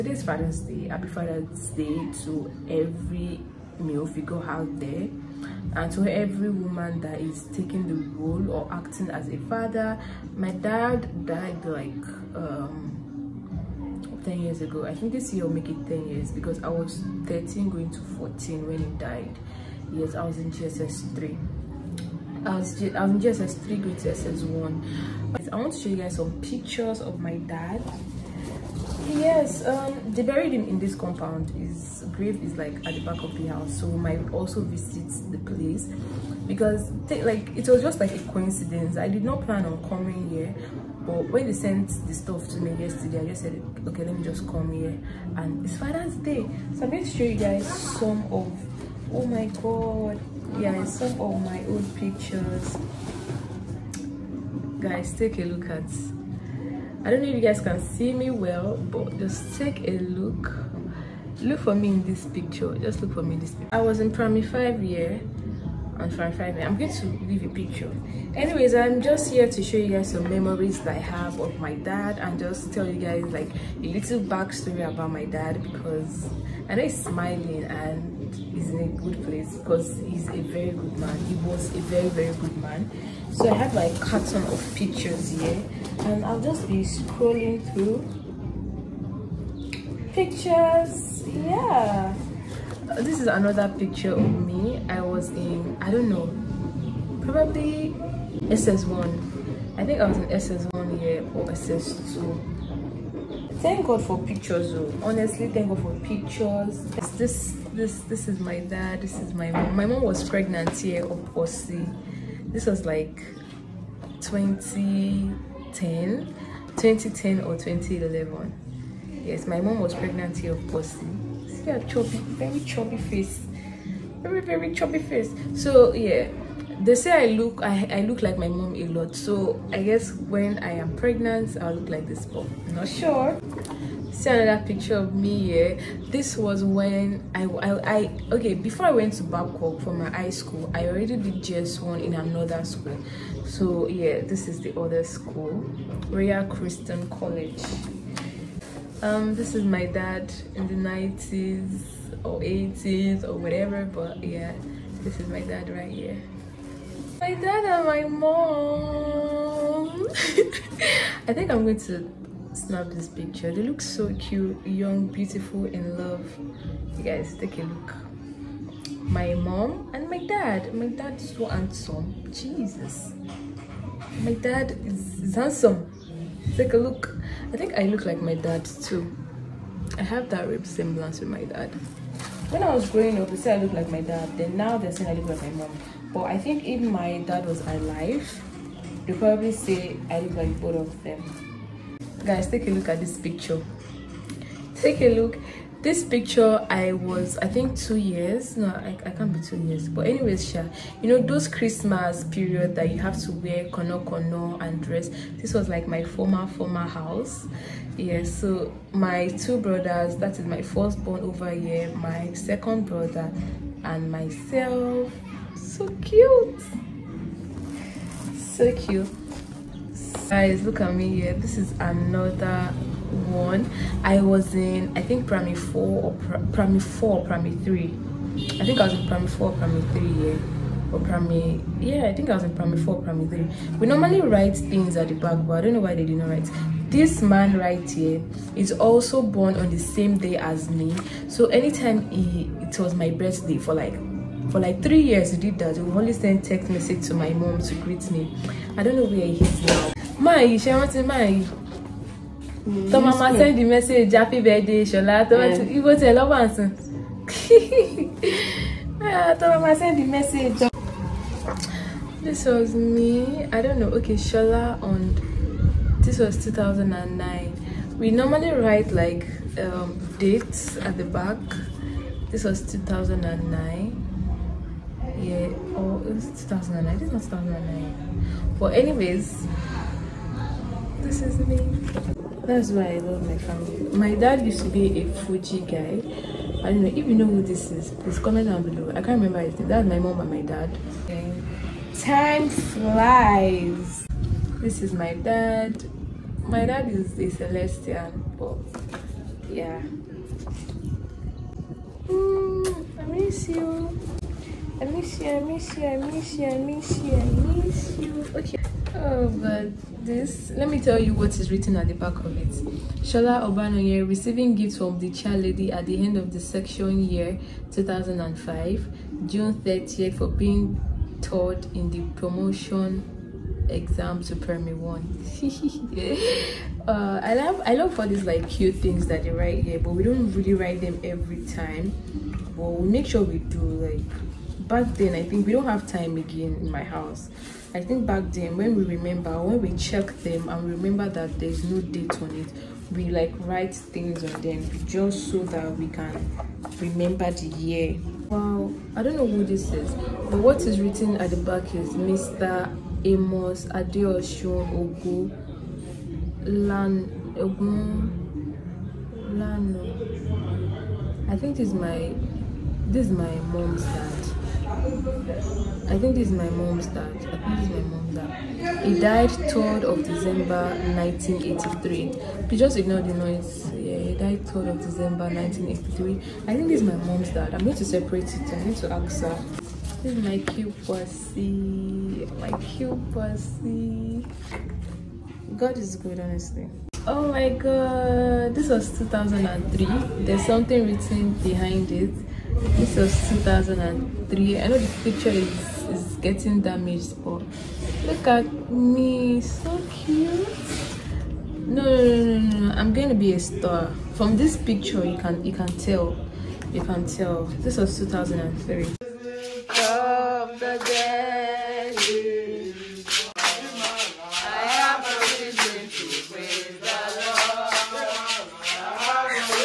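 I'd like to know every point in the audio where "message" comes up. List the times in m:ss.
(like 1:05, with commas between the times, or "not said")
4:06, 4:13, 4:20.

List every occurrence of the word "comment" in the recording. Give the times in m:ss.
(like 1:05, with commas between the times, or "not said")
4:48.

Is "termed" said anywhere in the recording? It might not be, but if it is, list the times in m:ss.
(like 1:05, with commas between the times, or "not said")
not said.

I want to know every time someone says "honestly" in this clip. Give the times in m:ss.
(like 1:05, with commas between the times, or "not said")
1:45, 6:26.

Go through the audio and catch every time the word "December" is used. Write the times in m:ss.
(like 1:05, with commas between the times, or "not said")
6:10, 6:14.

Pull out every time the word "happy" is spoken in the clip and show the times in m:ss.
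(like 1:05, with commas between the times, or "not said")
0:00, 4:14.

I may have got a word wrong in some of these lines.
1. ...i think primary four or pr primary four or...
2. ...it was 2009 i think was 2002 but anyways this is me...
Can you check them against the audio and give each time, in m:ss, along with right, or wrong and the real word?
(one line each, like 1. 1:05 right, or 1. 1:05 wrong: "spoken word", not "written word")
1. 3:44 right
2. 4:36 wrong: "2009", not "2002".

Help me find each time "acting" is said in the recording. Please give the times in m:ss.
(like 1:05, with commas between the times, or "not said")
0:08.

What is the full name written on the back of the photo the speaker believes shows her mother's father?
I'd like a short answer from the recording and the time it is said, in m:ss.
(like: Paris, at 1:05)
Mr Amos Adeosun, at 5:51.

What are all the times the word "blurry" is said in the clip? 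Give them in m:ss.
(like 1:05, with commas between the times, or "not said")
not said.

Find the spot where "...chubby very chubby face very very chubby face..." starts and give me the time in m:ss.
2:01.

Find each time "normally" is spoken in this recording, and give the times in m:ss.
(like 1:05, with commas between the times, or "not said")
3:53, 4:28.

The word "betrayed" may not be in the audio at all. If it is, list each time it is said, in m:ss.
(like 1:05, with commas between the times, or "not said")
not said.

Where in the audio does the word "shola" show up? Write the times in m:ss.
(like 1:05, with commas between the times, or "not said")
4:24, 5:13.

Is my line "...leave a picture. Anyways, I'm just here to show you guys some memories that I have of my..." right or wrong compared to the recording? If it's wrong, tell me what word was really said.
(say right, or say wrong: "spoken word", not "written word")
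right.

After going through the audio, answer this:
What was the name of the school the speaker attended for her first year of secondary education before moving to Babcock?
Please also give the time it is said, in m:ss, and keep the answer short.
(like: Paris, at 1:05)
Royal Christian College, at 2:26.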